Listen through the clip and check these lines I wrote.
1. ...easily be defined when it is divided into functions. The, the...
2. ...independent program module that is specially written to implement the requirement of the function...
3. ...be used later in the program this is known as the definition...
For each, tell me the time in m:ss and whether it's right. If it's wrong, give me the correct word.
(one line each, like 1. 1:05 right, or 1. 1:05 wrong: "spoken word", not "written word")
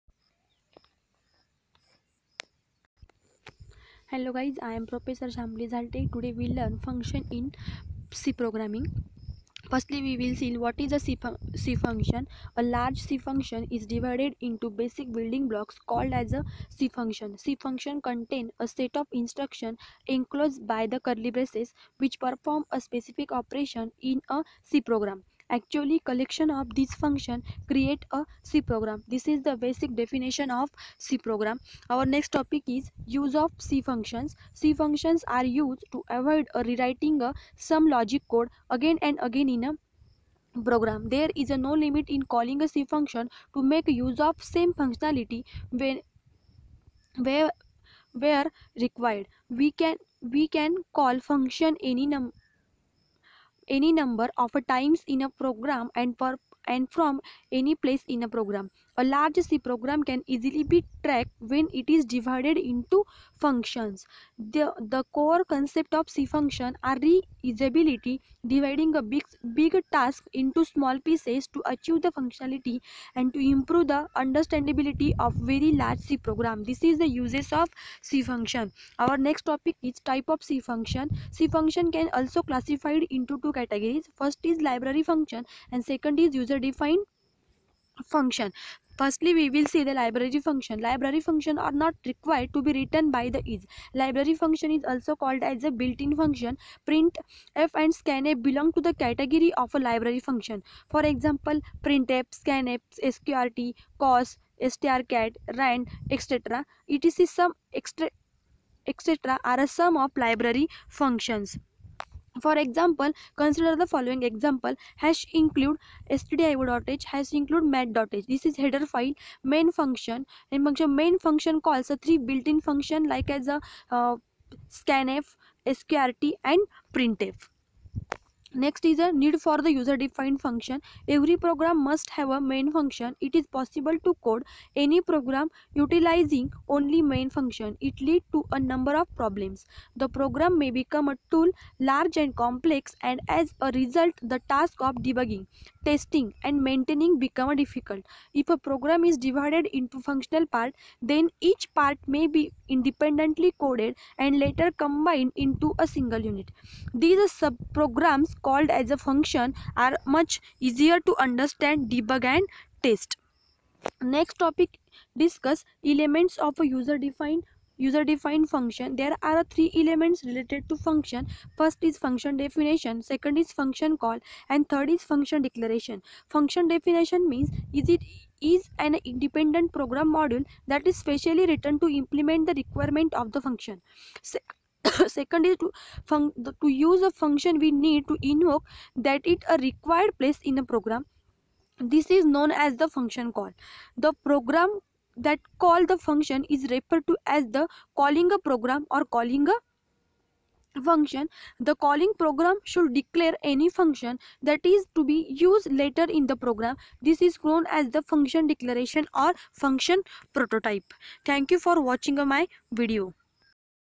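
1. 1:00 wrong: "tracked", not "defined"
2. 2:59 right
3. 3:25 wrong: "function", not "definition".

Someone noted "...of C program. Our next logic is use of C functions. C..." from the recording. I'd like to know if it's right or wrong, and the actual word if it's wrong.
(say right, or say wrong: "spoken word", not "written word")
wrong: "topic", not "logic".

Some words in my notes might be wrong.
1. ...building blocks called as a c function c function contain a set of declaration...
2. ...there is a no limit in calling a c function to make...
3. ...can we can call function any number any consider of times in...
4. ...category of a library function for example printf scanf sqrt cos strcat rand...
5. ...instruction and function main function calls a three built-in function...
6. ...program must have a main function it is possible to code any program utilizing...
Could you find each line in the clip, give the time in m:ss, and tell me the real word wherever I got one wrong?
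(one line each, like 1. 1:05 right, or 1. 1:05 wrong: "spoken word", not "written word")
1. 0:15 wrong: "instruction", not "declaration"
2. 0:41 right
3. 0:49 wrong: "number", not "consider"
4. 1:38 right
5. 1:59 wrong: "function", not "instruction"
6. 2:11 right.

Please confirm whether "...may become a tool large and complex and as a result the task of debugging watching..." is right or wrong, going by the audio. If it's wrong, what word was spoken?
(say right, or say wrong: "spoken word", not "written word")
wrong: "testing", not "watching".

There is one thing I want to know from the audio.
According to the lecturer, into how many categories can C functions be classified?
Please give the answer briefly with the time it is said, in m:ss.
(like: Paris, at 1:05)
2, at 1:23.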